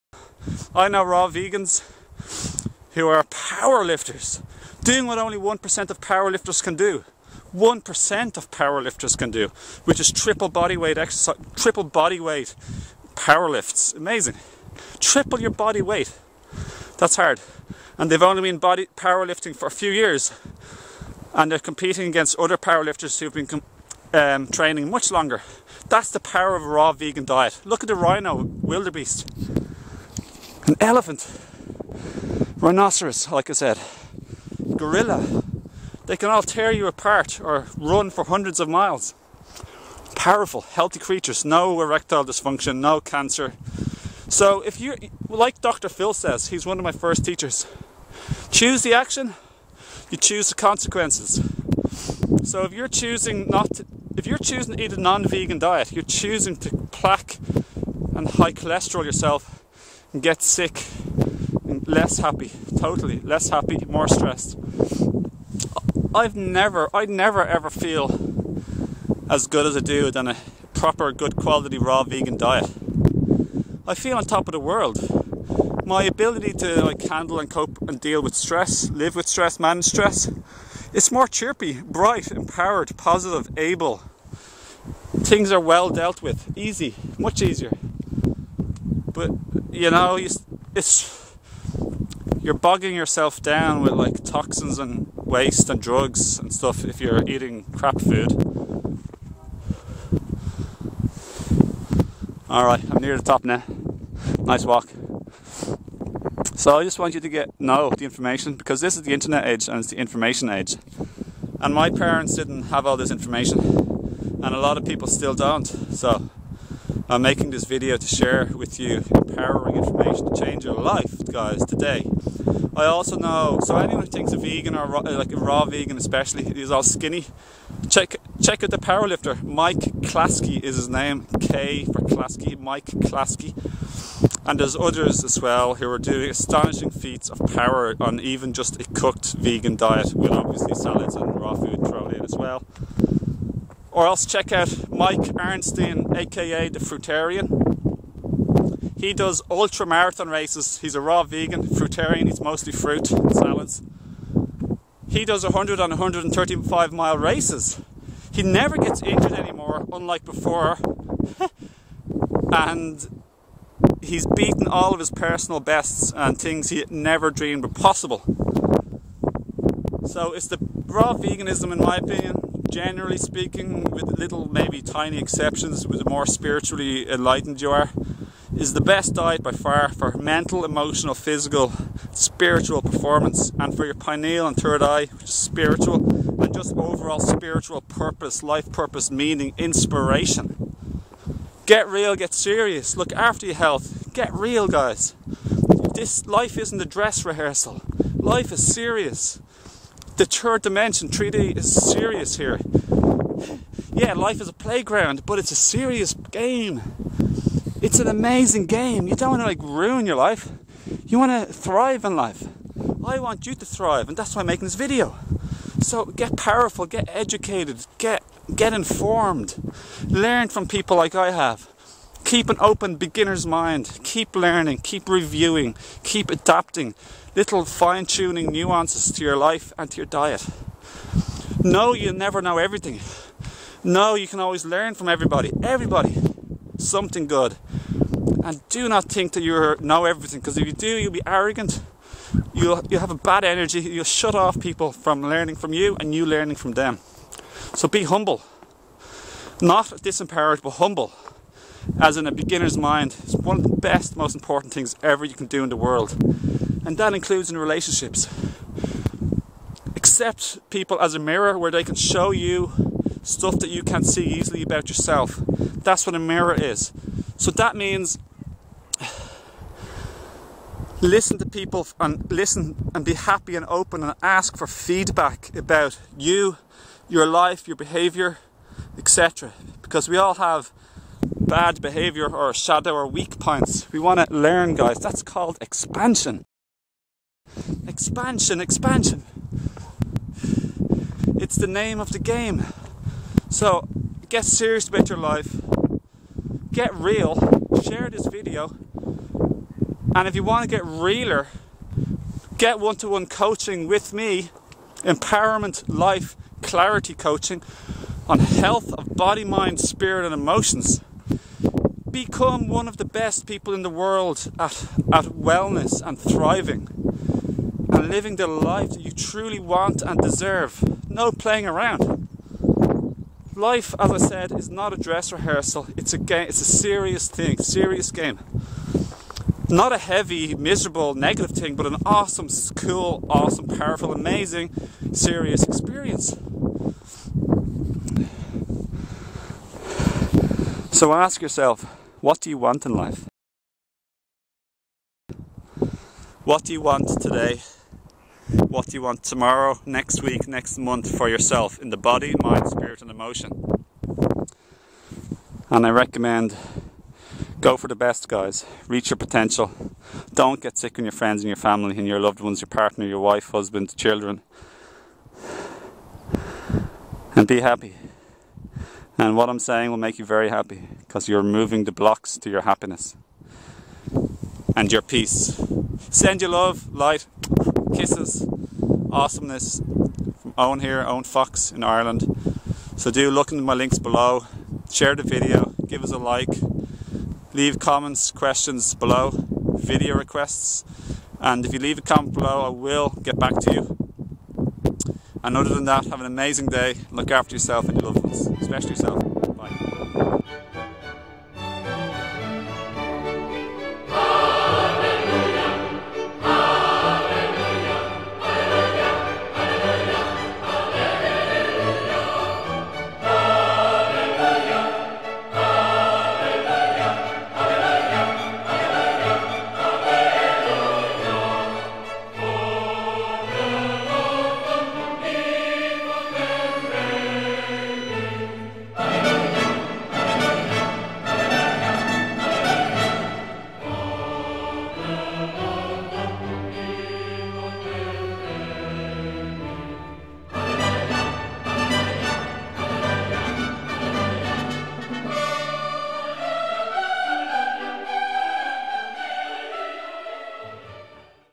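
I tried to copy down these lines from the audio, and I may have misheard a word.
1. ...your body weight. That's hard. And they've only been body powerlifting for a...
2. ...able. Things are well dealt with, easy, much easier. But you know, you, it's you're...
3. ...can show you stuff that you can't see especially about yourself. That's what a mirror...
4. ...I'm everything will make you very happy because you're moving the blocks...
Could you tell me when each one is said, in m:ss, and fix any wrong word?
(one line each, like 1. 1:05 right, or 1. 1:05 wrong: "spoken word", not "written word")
1. 0:15 right
2. 1:23 right
3. 4:21 wrong: "easily", not "especially"
4. 6:09 wrong: "saying", not "everything".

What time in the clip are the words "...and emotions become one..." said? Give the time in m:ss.
5:10.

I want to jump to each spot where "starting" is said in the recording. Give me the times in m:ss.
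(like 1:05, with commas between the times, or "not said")
not said.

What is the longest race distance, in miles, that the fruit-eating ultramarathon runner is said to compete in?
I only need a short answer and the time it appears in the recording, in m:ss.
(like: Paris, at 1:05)
135, at 2:35.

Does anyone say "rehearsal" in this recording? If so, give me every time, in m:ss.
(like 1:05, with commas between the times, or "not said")
3:17, 5:25.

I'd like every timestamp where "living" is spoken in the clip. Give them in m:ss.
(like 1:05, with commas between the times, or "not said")
5:18.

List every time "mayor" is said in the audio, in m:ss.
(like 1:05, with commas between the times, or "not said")
not said.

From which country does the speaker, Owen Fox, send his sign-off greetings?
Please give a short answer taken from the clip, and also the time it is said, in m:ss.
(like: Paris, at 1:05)
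Ireland, at 6:21.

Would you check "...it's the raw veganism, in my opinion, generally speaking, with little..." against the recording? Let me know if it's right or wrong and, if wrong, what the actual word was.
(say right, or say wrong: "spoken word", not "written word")
right.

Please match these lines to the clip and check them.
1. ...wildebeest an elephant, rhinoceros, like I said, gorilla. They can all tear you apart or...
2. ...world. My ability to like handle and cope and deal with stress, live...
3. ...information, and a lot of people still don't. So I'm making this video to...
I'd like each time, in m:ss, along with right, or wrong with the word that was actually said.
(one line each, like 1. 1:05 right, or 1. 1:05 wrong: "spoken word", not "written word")
1. 0:28 right
2. 1:14 right
3. 1:53 right.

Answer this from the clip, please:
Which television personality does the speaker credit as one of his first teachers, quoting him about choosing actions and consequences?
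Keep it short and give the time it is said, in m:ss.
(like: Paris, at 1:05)
Dr. Phil, at 0:45.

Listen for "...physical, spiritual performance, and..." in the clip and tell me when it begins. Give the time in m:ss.
3:01.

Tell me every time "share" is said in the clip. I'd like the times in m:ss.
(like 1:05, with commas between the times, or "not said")
1:58, 4:57, 6:24.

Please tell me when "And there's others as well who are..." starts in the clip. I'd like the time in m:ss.
2:14.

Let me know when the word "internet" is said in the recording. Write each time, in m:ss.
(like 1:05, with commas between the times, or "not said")
1:49.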